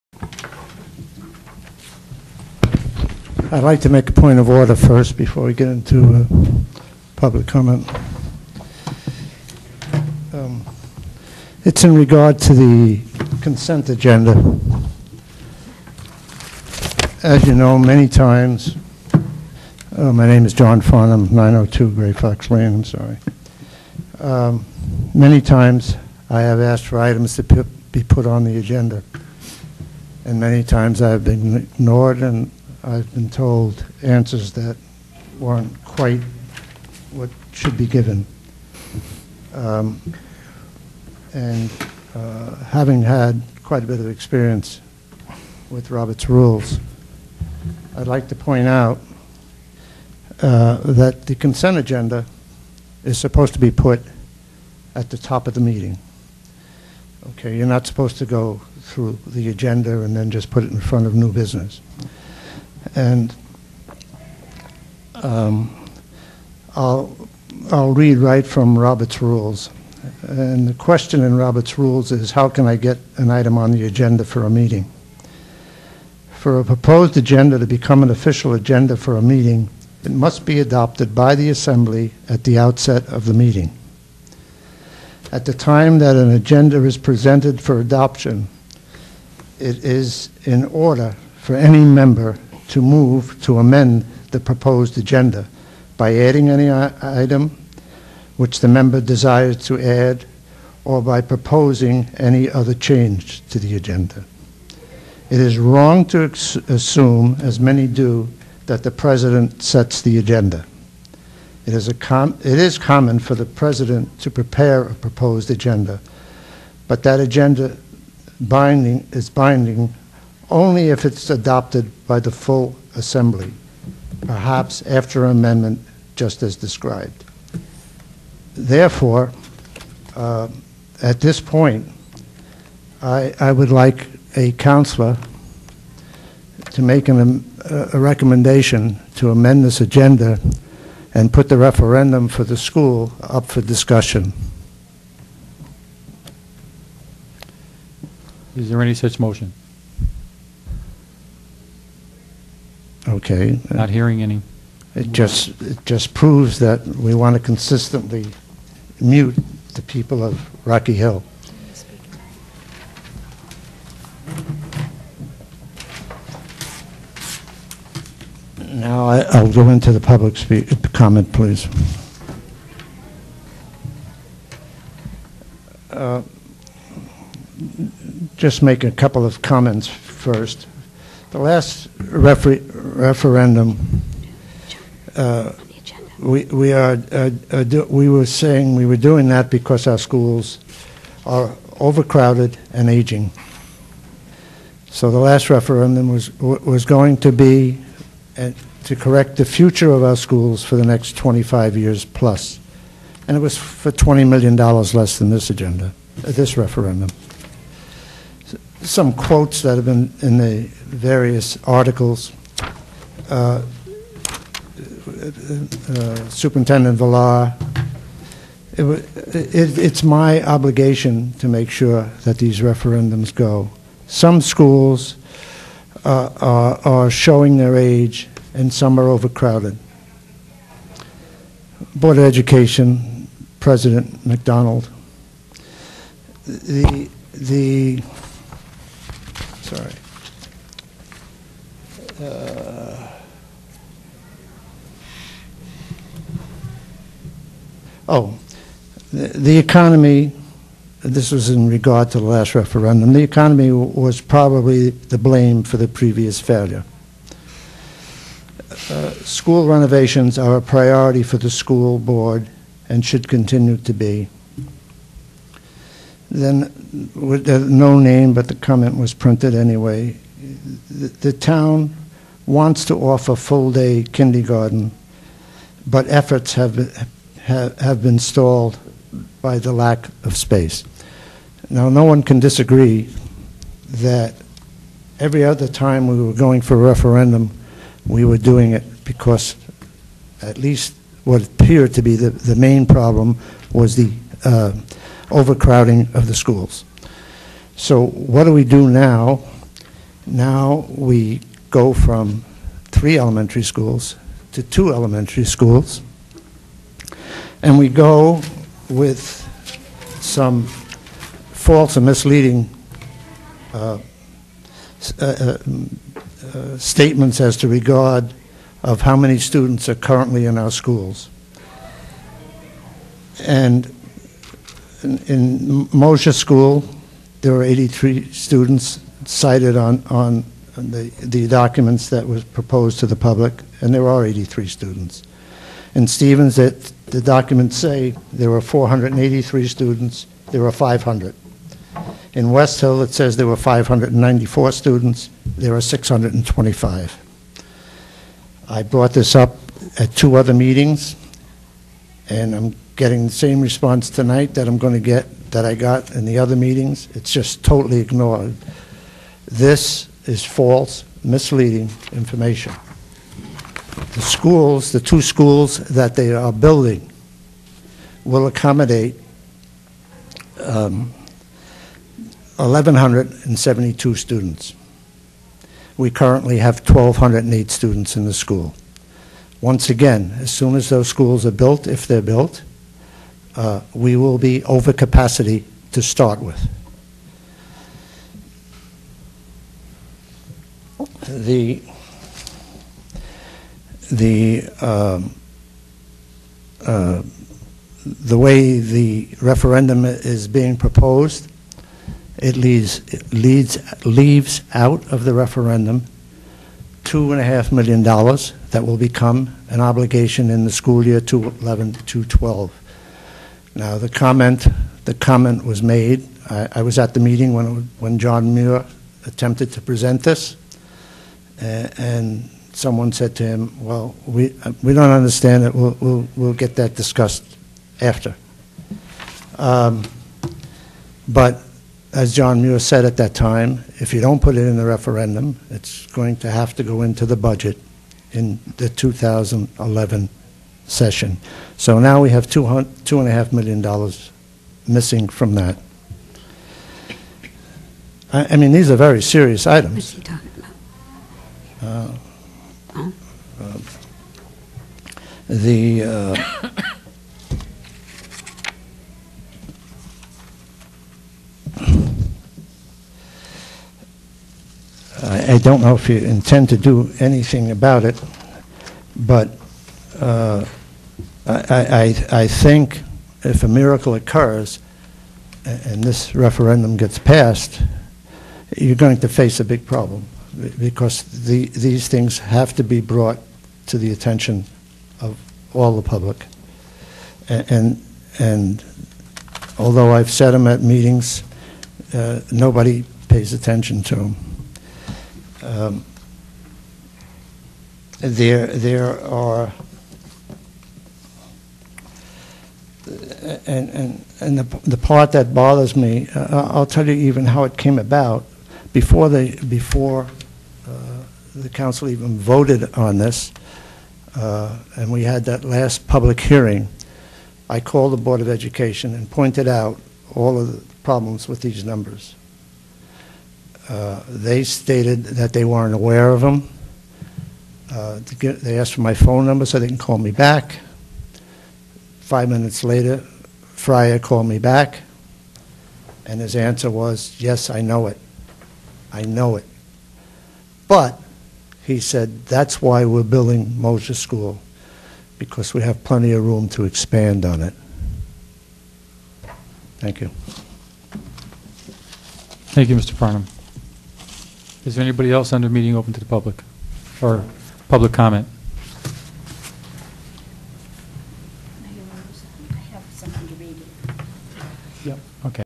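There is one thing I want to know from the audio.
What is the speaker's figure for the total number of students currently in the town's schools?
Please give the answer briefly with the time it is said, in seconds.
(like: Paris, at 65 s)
1,208, at 376 s.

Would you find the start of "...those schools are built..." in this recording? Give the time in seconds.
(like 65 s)
380 s.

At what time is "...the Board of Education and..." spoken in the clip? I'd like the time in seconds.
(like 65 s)
518 s.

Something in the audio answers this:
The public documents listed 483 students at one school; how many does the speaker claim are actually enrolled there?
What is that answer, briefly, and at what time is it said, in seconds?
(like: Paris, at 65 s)
500, at 340 s.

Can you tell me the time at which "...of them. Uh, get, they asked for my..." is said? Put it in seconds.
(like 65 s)
526 s.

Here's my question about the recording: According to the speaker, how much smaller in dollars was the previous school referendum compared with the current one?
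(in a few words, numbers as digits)
$20 million.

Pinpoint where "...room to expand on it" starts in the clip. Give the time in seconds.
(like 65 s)
546 s.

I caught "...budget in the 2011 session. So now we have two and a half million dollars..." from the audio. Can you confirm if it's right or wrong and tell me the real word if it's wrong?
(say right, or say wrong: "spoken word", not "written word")
right.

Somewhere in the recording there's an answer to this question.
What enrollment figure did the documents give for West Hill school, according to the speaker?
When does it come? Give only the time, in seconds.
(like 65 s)
343 s.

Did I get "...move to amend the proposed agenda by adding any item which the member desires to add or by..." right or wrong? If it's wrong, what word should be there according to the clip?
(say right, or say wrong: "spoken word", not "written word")
right.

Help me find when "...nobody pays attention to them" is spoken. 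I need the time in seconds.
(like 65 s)
492 s.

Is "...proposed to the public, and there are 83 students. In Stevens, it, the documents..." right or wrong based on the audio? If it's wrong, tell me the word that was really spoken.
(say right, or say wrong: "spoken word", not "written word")
right.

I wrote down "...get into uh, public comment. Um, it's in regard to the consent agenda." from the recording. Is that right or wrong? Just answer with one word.
right.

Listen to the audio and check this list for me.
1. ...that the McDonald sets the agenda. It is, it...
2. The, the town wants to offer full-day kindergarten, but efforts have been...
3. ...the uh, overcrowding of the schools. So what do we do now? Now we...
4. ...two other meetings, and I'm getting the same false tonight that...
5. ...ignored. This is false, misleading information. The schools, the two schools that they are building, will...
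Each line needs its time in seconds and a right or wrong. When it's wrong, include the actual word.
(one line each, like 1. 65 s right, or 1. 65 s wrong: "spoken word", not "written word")
1. 108 s wrong: "President", not "McDonald"
2. 270 s right
3. 293 s right
4. 350 s wrong: "response", not "false"
5. 357 s right.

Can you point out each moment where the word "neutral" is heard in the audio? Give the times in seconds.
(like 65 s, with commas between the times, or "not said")
not said.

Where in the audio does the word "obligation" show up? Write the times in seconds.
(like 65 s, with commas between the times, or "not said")
220 s, 409 s.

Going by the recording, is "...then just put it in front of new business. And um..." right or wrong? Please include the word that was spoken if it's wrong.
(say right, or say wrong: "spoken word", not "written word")
right.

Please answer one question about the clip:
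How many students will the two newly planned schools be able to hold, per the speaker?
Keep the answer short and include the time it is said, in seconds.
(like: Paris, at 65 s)
1,172, at 372 s.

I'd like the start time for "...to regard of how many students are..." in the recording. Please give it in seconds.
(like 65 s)
317 s.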